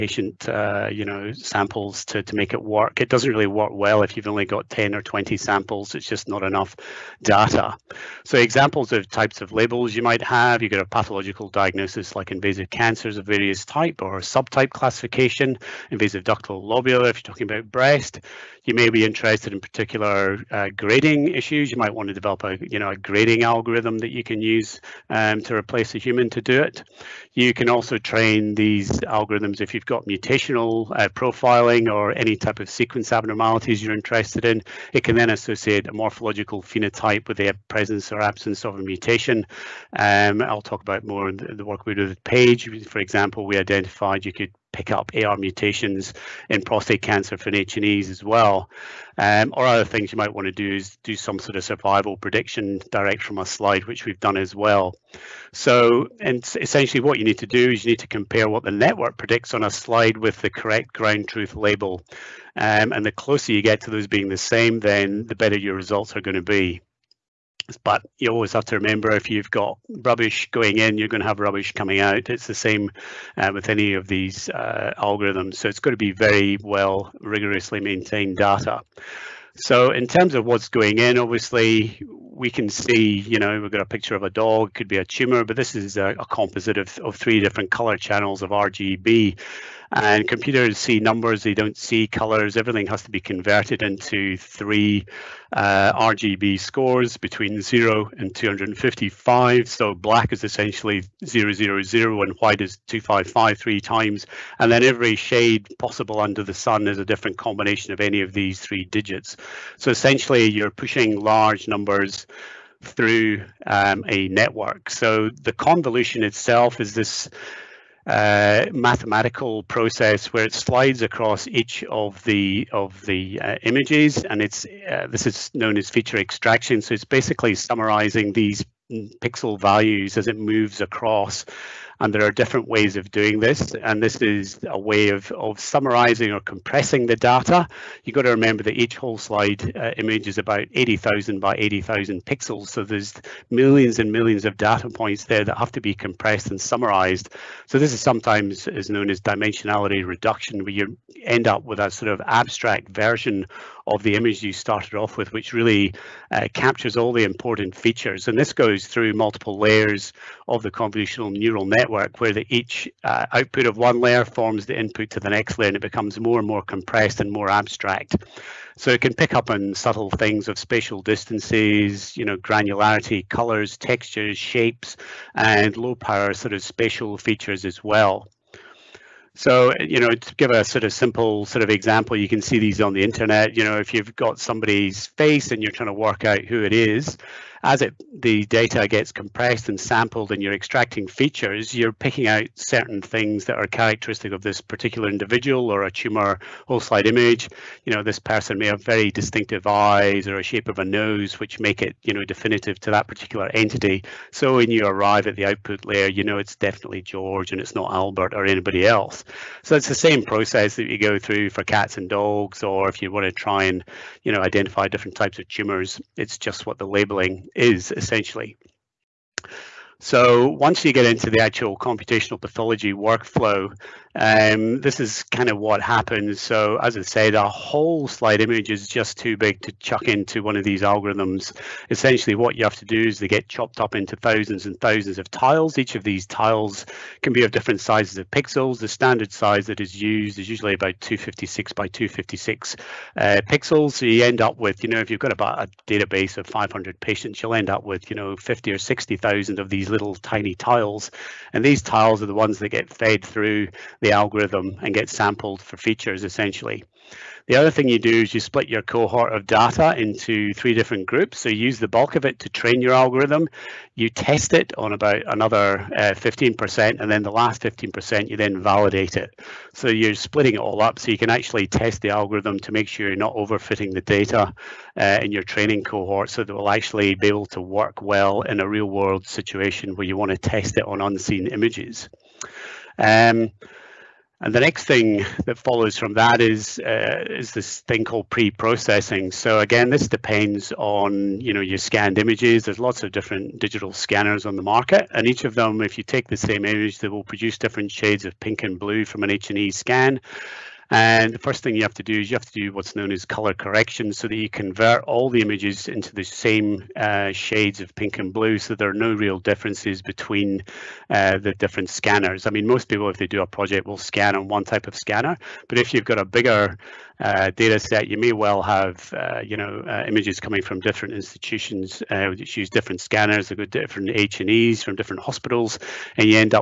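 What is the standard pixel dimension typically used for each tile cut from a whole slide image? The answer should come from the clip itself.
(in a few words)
256 by 256.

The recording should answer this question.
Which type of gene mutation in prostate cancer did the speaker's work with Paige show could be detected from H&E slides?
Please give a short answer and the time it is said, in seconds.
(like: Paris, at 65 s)
AR mutations, at 45 s.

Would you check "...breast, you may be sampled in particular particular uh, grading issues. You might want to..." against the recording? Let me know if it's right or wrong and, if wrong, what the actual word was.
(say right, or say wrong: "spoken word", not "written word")
wrong: "interested", not "sampled".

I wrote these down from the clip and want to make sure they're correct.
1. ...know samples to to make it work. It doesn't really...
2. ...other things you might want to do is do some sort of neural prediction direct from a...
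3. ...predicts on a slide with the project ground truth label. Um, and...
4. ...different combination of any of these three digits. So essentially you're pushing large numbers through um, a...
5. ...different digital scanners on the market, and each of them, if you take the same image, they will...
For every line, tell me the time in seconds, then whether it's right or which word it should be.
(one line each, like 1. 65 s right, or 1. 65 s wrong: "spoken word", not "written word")
1. 1 s right
2. 49 s wrong: "survival", not "neural"
3. 59 s wrong: "correct", not "project"
4. 107 s right
5. 293 s right.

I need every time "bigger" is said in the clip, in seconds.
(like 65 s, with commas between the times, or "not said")
316 s.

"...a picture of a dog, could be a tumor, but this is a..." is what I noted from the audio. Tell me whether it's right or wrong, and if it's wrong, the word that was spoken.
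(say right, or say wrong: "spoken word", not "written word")
right.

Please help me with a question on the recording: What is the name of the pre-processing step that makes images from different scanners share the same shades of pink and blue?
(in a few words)
Color correction.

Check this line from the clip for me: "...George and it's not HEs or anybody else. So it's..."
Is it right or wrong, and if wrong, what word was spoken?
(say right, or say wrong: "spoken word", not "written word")
wrong: "Albert", not "HEs".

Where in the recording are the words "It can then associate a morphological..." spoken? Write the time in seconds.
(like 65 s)
34 s.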